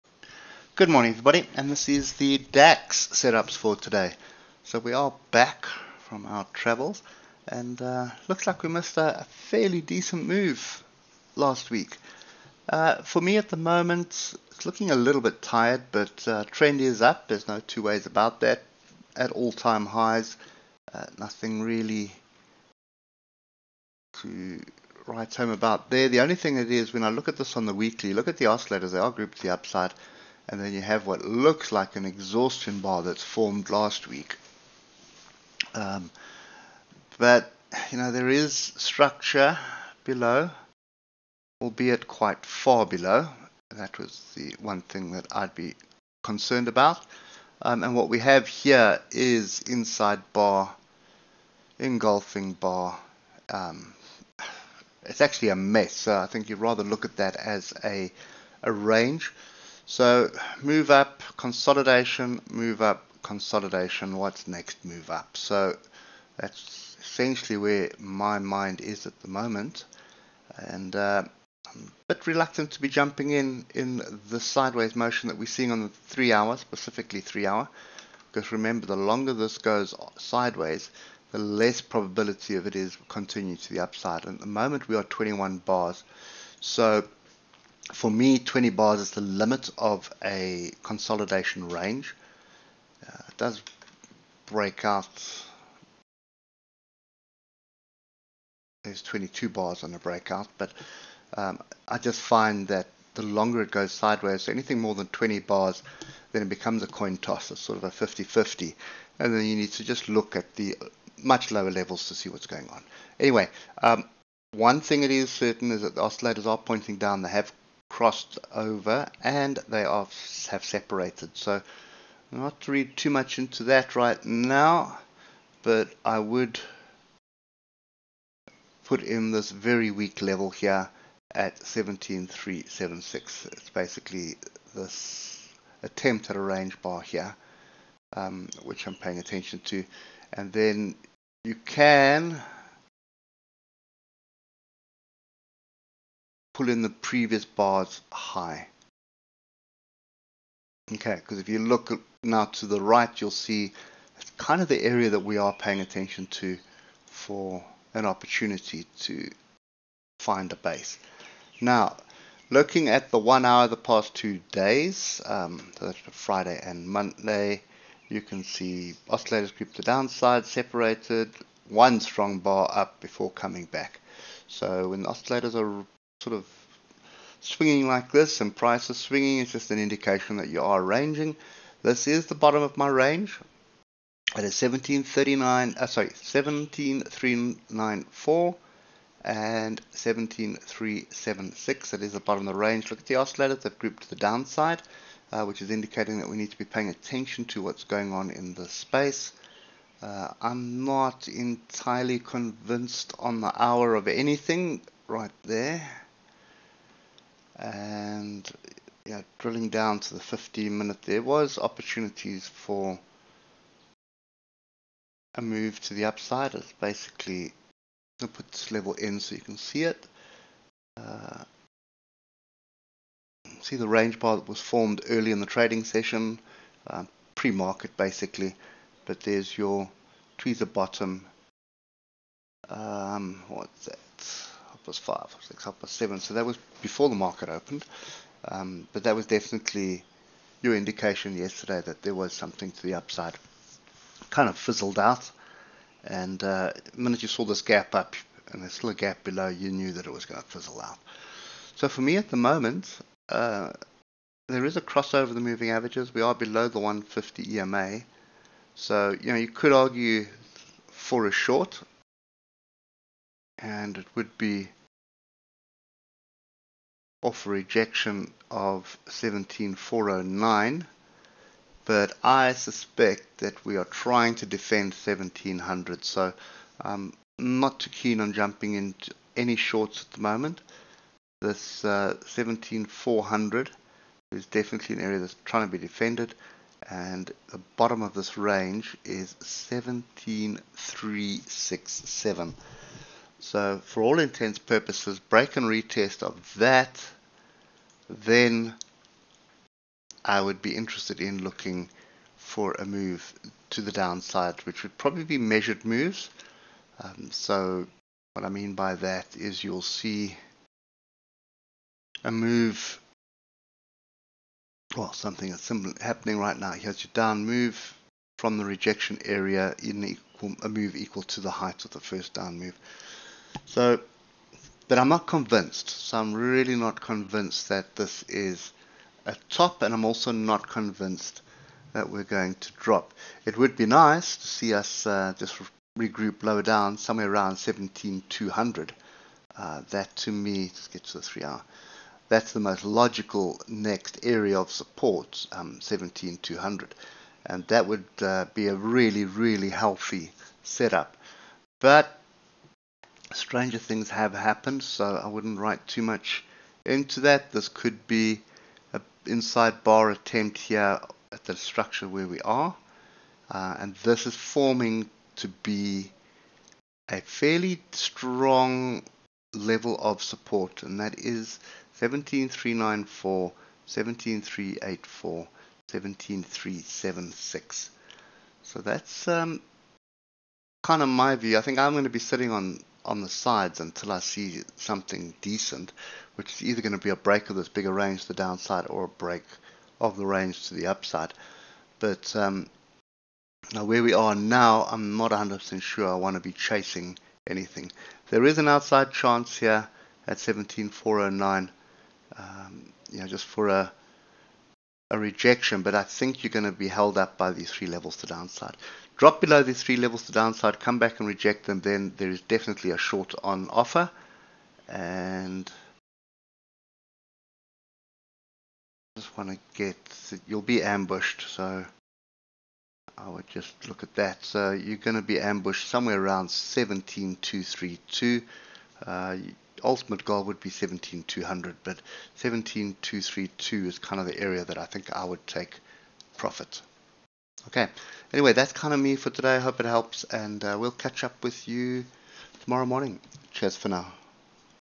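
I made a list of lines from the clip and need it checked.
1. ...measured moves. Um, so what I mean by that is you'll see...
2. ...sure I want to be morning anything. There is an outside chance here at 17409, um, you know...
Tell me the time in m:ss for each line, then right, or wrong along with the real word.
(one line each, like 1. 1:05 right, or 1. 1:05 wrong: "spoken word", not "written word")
1. 5:05 right
2. 6:35 wrong: "chasing", not "morning".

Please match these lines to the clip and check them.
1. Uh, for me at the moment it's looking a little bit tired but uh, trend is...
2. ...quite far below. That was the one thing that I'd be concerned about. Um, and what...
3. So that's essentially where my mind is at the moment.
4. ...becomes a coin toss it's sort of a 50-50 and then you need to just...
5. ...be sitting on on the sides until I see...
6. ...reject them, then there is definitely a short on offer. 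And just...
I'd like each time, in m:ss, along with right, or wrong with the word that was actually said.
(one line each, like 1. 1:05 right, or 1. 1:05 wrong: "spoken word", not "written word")
1. 0:12 right
2. 0:42 right
3. 1:05 right
4. 1:46 right
5. 6:22 right
6. 6:51 right.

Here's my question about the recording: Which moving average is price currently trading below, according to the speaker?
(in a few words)
150 EMA.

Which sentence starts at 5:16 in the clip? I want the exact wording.
Here's your down move from the rejection area in equal, a move equal to the height of the first down move.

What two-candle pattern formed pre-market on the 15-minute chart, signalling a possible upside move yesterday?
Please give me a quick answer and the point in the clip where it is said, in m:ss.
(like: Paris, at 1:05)
Tweezer bottom, at 3:50.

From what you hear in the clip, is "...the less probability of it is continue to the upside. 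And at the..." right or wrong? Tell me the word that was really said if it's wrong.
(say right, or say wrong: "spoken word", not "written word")
right.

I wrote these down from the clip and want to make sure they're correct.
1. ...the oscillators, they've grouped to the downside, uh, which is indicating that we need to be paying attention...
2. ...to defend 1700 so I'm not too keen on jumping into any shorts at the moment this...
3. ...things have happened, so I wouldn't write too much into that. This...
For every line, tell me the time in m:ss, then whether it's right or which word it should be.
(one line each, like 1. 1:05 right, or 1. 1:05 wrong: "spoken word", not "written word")
1. 3:13 right
2. 4:34 right
3. 5:53 right.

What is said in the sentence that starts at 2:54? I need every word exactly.
So when the oscillators are sort of swinging like this and prices swinging is just an indication that you are ranging.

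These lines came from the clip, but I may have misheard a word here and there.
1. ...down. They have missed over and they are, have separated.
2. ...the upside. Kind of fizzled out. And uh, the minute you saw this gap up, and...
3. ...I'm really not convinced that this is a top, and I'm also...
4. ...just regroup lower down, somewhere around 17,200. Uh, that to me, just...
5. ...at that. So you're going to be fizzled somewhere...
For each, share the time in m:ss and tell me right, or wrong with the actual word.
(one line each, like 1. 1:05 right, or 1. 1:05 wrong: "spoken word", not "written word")
1. 1:56 wrong: "crossed", not "missed"
2. 4:02 right
3. 5:26 right
4. 5:35 right
5. 7:04 wrong: "ambushed", not "fizzled".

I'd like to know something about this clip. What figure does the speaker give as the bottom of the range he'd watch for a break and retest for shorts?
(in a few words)
17,367.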